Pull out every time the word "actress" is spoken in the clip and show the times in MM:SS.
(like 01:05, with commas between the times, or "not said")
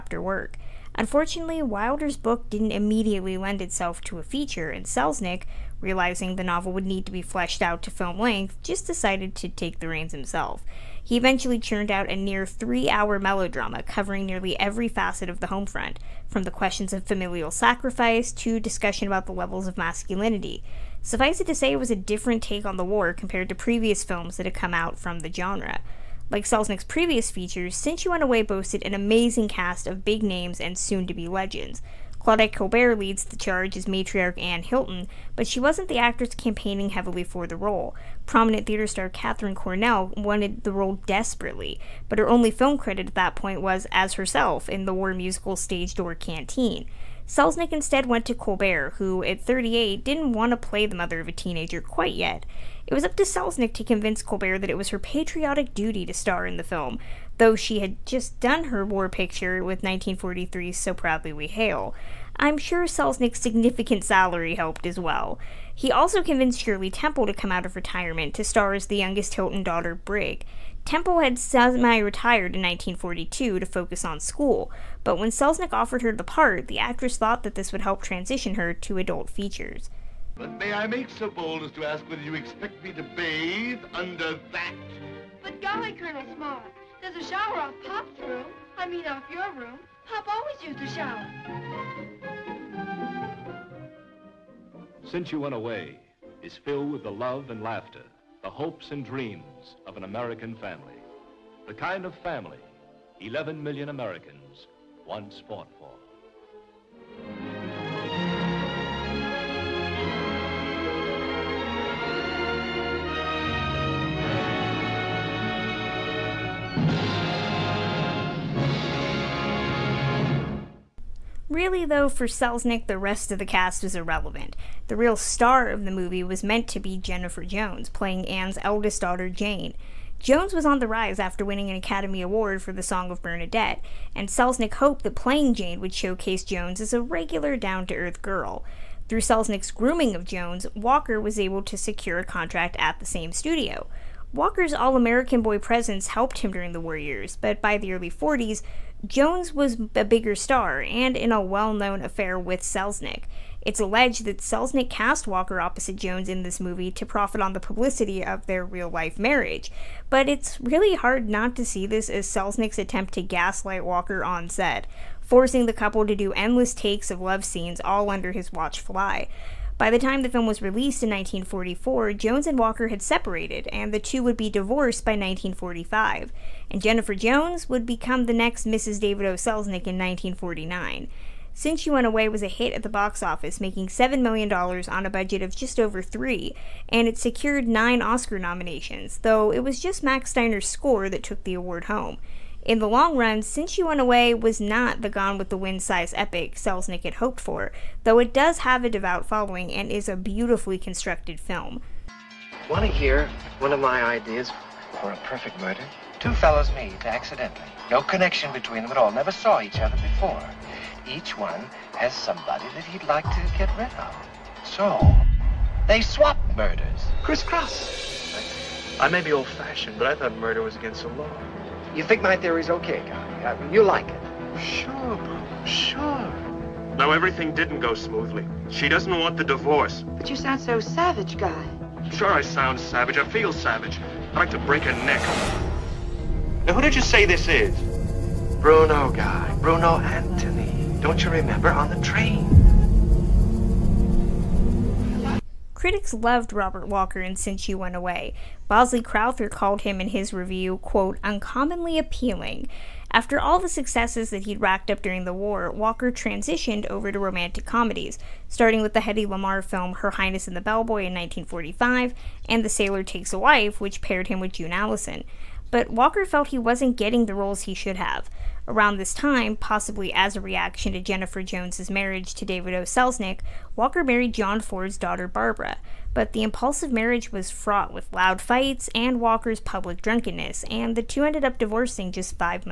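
00:35, 01:16.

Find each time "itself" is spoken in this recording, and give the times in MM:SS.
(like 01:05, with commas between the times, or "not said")
00:03.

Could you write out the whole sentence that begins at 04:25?
But Walker felt he wasn't getting the roles he should have.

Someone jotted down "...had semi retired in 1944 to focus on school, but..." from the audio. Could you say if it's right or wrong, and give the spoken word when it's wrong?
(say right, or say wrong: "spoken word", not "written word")
wrong: "1942", not "1944".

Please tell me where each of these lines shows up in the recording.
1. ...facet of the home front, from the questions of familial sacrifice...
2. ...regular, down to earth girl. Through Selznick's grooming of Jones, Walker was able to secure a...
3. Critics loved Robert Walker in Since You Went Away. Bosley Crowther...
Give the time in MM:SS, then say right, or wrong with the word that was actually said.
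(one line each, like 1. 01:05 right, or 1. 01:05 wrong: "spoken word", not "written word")
1. 00:14 right
2. 02:17 right
3. 04:05 right.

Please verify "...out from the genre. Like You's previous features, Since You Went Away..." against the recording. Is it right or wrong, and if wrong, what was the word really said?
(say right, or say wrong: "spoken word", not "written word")
wrong: "Selznick", not "You".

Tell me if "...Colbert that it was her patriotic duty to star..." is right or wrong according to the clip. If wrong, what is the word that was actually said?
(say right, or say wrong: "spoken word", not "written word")
right.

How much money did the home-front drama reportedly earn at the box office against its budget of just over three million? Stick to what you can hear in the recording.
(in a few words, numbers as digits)
$7 million.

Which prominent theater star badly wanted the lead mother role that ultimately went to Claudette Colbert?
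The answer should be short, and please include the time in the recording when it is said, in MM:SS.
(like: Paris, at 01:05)
Katharine Cornell, at 00:39.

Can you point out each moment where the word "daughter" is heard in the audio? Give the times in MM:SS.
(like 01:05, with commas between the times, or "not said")
01:09, 02:08, 04:34.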